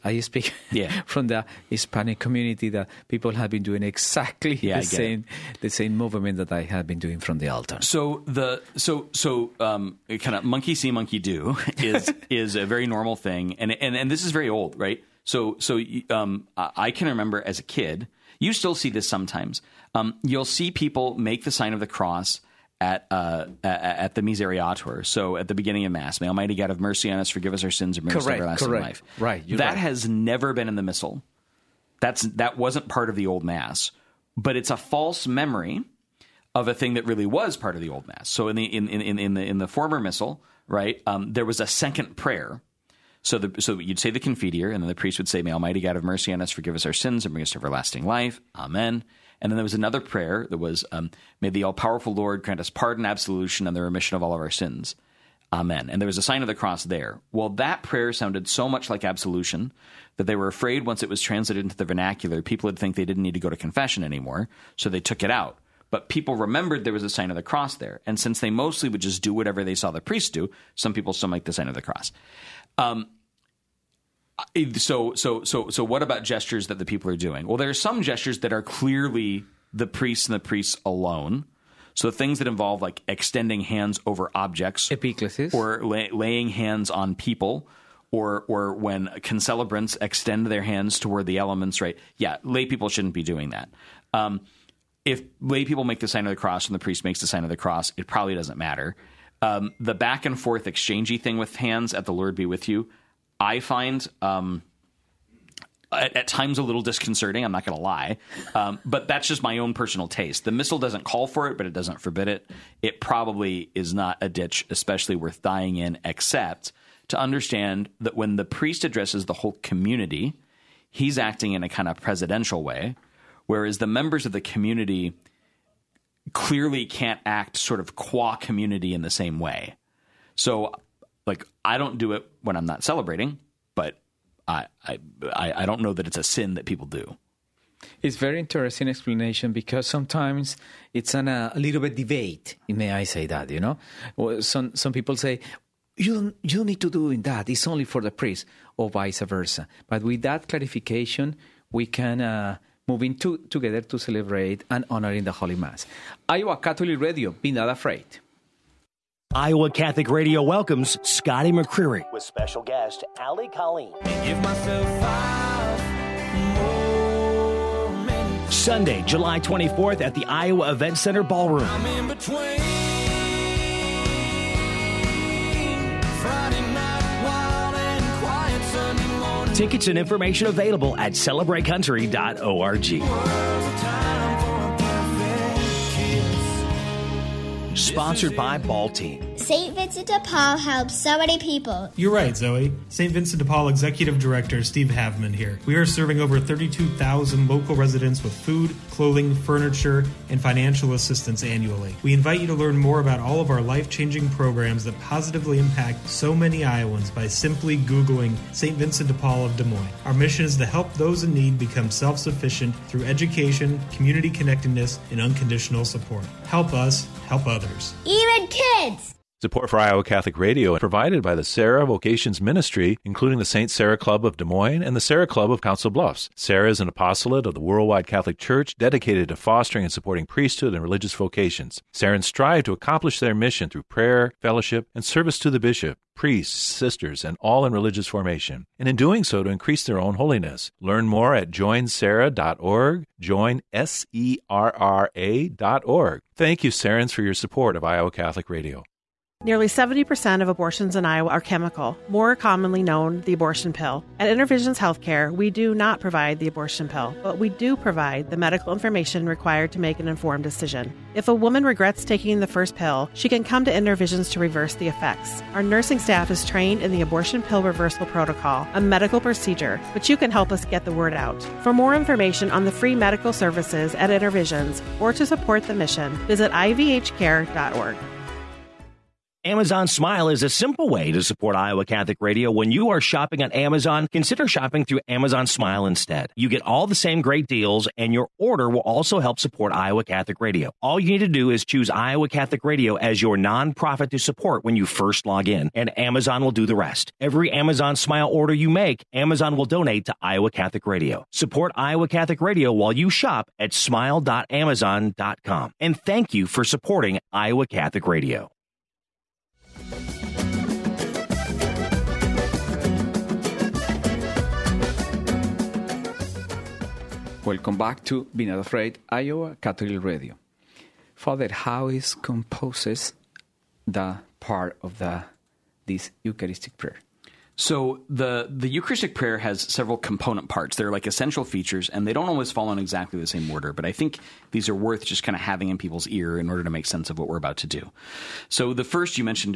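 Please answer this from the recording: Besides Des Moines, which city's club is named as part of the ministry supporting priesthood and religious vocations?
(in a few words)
Council Bluffs.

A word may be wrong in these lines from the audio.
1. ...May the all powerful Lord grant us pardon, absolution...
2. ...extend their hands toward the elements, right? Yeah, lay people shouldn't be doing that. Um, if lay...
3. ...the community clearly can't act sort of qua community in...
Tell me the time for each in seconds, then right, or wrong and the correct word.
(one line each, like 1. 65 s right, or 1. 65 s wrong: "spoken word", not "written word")
1. 51 s right
2. 90 s right
3. 124 s right.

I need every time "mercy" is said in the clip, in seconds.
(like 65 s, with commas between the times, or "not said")
26 s, 46 s.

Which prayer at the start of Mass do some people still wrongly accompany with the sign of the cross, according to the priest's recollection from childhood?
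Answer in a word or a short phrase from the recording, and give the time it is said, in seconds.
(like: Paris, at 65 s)
Misereatur, at 24 s.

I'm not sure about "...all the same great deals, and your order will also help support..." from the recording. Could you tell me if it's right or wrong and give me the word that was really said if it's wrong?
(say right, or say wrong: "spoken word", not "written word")
right.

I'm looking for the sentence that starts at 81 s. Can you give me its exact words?
So things that involve like extending hands over objects, Epiclesis.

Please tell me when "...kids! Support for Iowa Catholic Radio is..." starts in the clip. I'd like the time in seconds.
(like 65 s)
218 s.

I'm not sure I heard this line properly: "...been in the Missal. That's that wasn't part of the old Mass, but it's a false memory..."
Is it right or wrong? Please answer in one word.
right.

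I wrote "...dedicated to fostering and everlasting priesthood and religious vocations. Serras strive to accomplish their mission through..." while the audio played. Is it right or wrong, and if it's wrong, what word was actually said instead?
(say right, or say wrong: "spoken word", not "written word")
wrong: "supporting", not "everlasting".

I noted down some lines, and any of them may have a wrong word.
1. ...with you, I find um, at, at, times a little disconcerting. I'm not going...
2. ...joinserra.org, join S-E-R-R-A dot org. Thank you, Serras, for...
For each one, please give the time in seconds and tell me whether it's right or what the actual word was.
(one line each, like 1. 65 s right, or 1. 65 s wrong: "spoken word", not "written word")
1. 102 s right
2. 241 s right.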